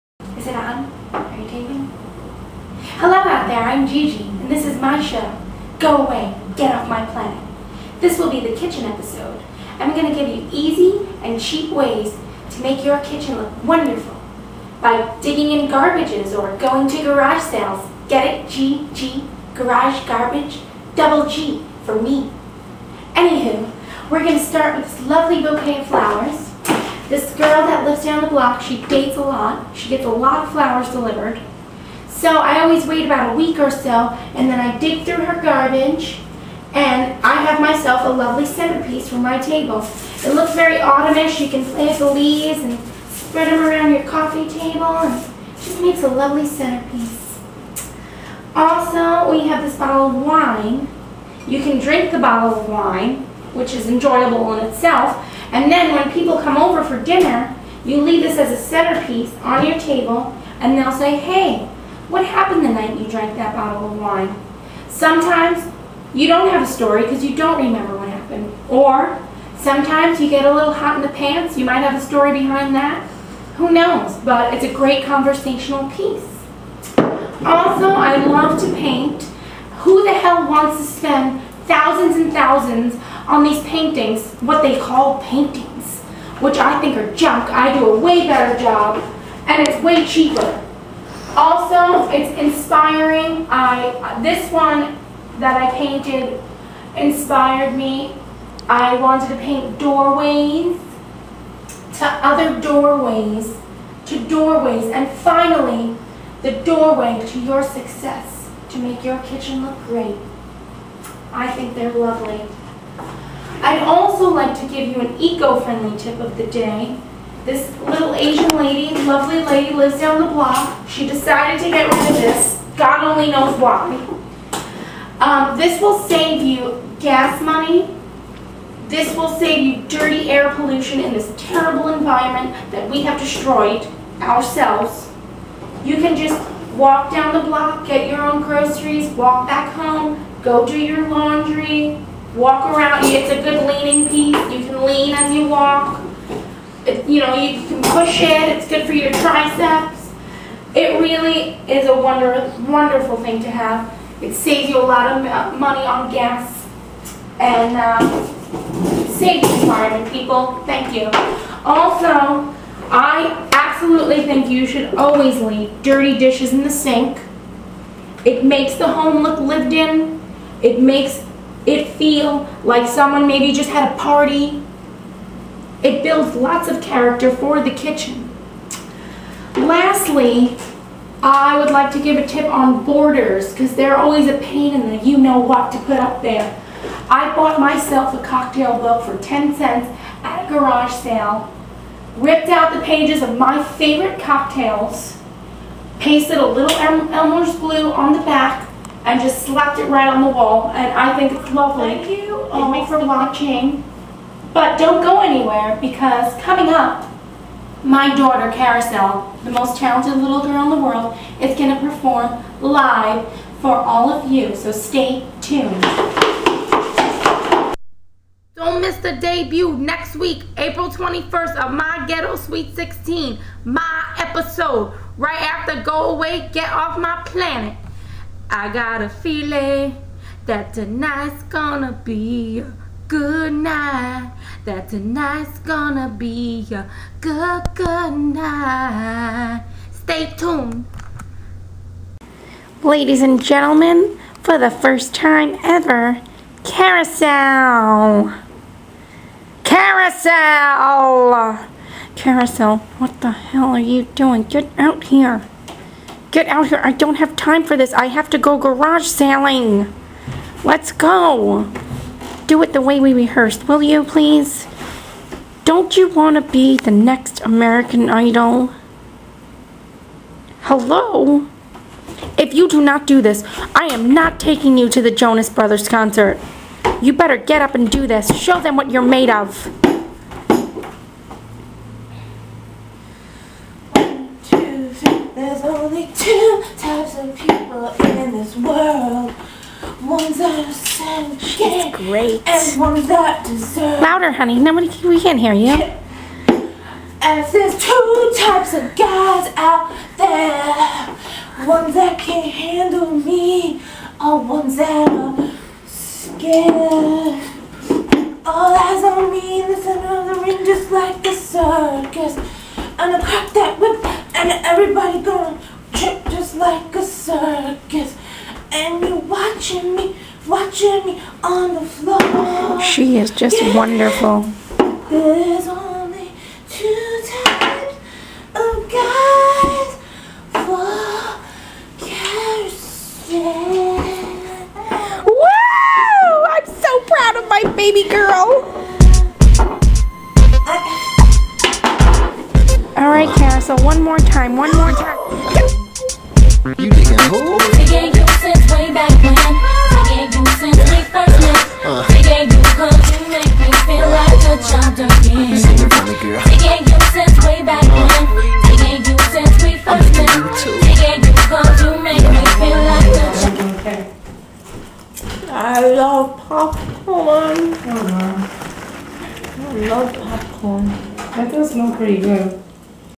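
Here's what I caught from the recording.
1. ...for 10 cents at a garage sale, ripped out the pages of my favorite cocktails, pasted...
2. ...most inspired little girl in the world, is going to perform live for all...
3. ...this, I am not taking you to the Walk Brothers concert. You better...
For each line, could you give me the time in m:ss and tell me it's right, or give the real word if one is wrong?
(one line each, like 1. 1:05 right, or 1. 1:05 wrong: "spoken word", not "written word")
1. 3:09 right
2. 3:29 wrong: "talented", not "inspired"
3. 4:33 wrong: "Jonas", not "Walk".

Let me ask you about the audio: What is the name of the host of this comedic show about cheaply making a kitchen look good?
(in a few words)
Gigi.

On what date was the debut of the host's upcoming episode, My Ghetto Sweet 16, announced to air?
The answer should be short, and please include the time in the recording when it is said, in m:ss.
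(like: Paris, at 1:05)
April 21st, at 3:40.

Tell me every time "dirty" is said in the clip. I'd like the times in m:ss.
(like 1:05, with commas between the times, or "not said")
2:09, 2:45.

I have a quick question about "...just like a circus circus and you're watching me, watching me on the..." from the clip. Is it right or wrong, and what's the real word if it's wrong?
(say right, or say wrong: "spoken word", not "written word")
right.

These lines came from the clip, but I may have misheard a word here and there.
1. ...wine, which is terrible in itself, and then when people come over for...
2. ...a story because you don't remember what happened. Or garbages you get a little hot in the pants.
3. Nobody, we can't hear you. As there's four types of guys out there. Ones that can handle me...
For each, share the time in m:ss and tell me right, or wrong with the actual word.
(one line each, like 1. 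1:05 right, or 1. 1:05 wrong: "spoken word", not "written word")
1. 0:52 wrong: "enjoyable", not "terrible"
2. 1:06 wrong: "sometimes", not "garbages"
3. 4:54 wrong: "two", not "four".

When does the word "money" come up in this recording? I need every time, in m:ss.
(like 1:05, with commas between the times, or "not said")
2:07, 2:35.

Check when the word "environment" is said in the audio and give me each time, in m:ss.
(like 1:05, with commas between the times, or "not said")
2:11, 2:39.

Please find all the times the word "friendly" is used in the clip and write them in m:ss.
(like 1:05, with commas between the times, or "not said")
1:55.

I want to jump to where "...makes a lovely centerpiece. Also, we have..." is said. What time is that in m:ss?
0:45.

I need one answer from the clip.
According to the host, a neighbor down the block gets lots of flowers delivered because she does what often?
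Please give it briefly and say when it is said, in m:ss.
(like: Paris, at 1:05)
Dates, at 0:28.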